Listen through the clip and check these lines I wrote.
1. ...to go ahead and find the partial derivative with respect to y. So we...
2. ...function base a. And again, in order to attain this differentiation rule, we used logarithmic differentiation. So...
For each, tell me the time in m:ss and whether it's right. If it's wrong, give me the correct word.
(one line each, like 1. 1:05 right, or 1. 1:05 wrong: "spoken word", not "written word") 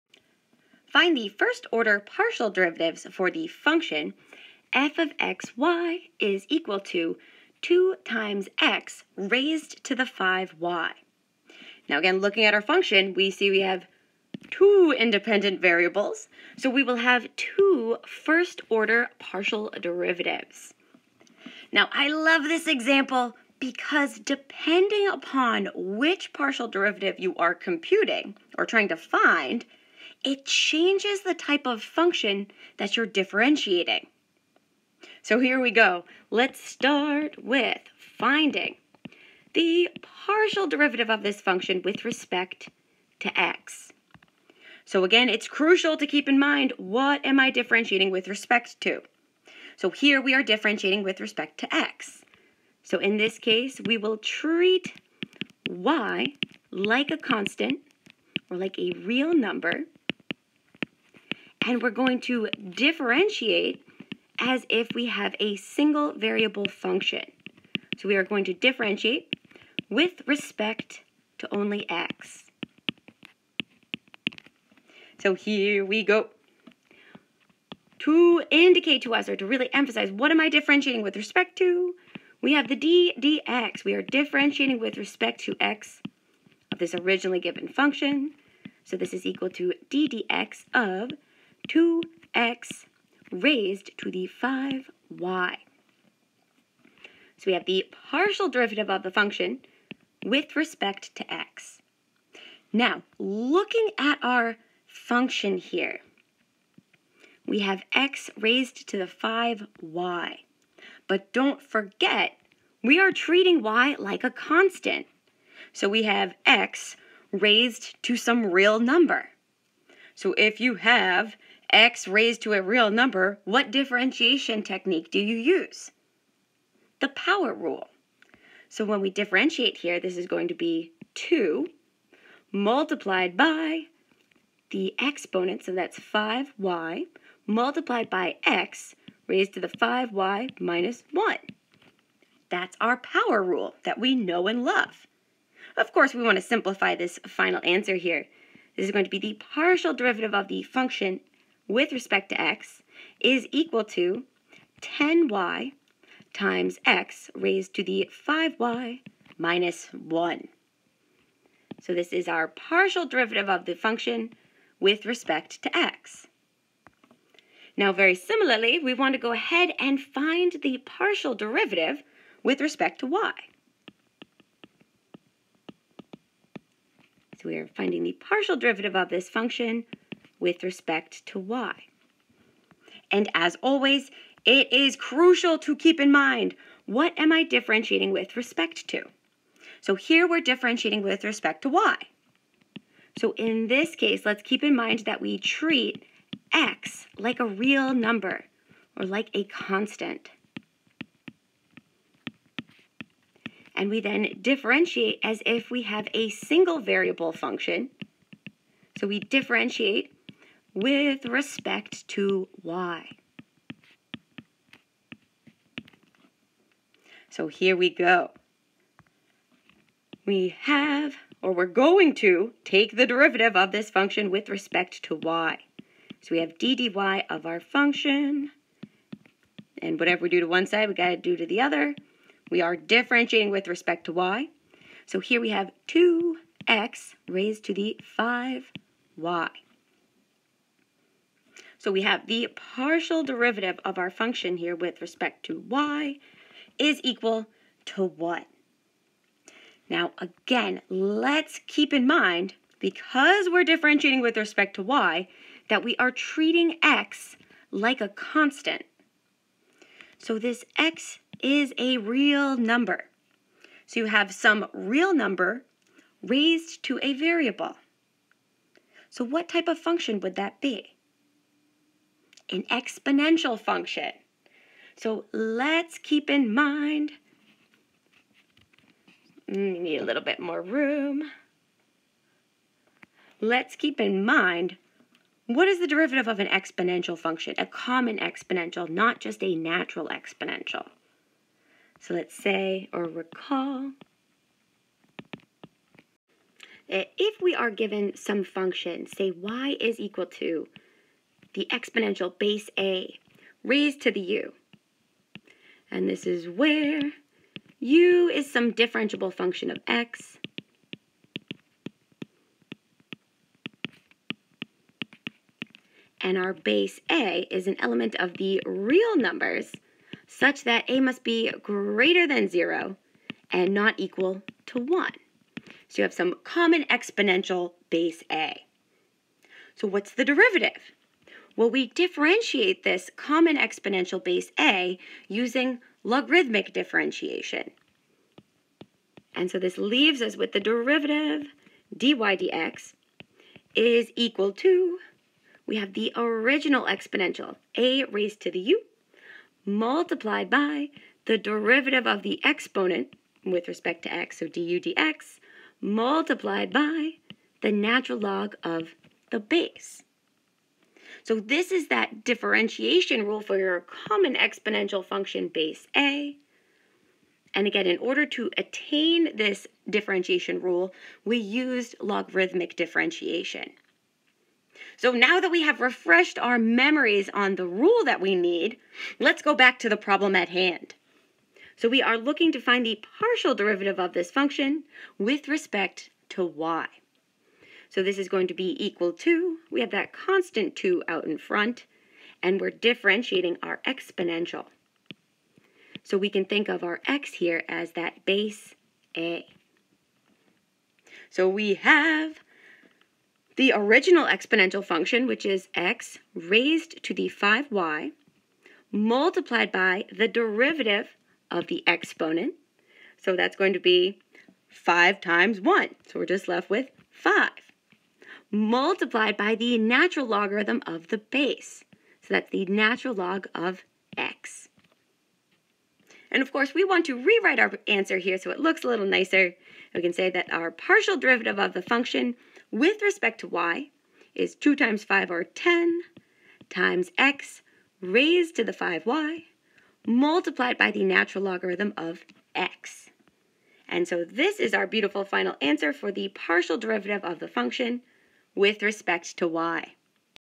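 1. 2:49 right
2. 6:05 right.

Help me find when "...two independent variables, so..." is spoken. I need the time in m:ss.
0:14.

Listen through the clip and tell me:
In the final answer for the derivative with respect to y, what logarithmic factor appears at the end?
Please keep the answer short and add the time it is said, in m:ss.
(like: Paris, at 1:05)
Natural logarithm of x, at 7:21.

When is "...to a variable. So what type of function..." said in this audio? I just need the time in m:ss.
4:26.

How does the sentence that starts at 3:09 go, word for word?
So here we're differentiating with respect to y.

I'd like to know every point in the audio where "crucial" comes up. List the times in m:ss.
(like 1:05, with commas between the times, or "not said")
0:45, 3:04.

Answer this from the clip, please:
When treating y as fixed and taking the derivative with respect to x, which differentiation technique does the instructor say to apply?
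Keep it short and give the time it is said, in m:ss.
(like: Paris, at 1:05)
The power rule, at 2:06.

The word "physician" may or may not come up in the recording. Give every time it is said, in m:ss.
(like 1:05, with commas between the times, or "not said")
not said.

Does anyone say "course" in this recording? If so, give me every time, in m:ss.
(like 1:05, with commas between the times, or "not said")
2:25, 7:06.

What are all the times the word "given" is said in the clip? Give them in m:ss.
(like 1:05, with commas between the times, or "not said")
1:27, 4:57.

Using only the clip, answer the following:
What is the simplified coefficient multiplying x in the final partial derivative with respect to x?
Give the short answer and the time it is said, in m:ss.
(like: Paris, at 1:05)
10y, at 2:34.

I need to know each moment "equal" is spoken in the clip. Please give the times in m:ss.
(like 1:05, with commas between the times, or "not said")
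0:06, 1:29, 2:33, 4:07, 4:59, 5:23, 5:44, 6:28.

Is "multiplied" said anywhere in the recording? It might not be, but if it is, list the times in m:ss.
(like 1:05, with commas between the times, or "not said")
2:12, 2:17, 5:49, 5:55, 6:48, 6:58, 7:20.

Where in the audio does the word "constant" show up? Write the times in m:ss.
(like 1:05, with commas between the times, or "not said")
0:57, 1:54, 3:19, 4:18, 6:30.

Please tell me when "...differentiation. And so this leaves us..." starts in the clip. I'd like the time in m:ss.
5:36.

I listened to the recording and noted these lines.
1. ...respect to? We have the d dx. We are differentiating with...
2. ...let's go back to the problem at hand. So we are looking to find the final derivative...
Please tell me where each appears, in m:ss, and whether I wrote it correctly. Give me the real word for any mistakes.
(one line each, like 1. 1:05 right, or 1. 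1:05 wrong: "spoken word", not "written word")
1. 1:21 right
2. 6:19 wrong: "partial", not "final".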